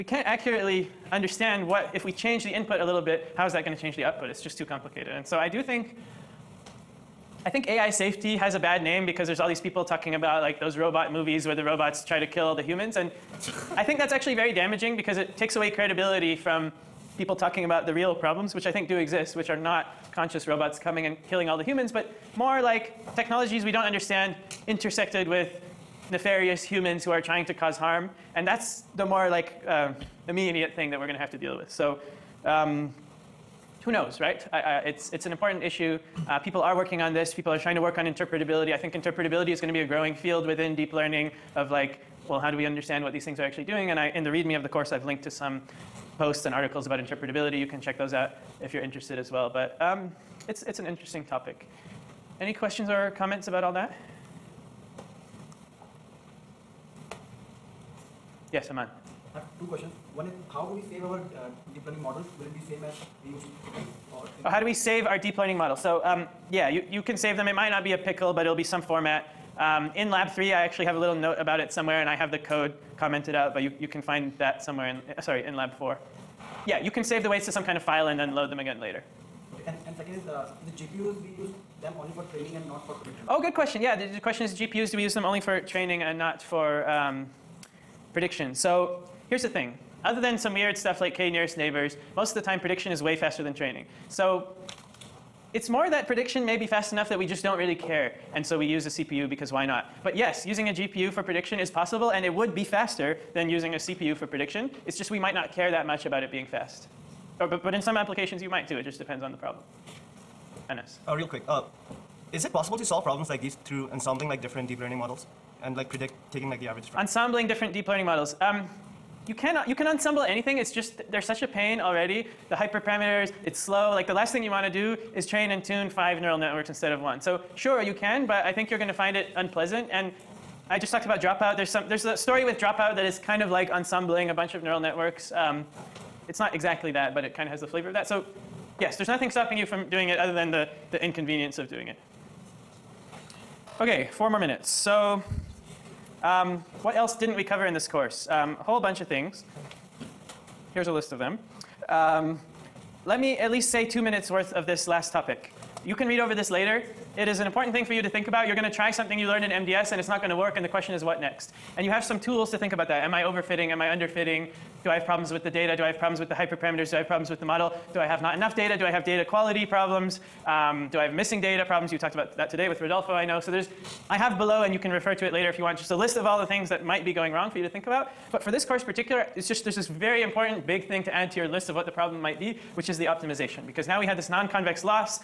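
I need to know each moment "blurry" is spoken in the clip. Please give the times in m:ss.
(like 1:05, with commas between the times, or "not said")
not said.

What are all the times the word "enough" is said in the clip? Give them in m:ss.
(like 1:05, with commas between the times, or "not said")
1:36, 2:48.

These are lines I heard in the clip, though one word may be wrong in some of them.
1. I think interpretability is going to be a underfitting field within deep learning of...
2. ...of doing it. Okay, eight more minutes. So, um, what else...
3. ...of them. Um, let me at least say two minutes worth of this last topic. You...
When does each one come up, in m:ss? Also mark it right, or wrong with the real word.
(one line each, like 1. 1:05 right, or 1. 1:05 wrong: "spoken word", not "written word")
1. 0:38 wrong: "growing", not "underfitting"
2. 2:21 wrong: "four", not "eight"
3. 2:31 right.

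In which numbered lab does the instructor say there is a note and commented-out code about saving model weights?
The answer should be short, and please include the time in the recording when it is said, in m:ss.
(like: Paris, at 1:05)
lab 4, at 1:15.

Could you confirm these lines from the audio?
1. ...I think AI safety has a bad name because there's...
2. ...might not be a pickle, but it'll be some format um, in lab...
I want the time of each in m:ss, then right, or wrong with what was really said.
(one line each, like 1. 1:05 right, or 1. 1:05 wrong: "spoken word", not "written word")
1. 0:07 right
2. 1:07 right.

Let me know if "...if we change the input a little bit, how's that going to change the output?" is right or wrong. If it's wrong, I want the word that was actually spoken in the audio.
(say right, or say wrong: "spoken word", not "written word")
right.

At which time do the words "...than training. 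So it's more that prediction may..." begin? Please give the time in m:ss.
1:33.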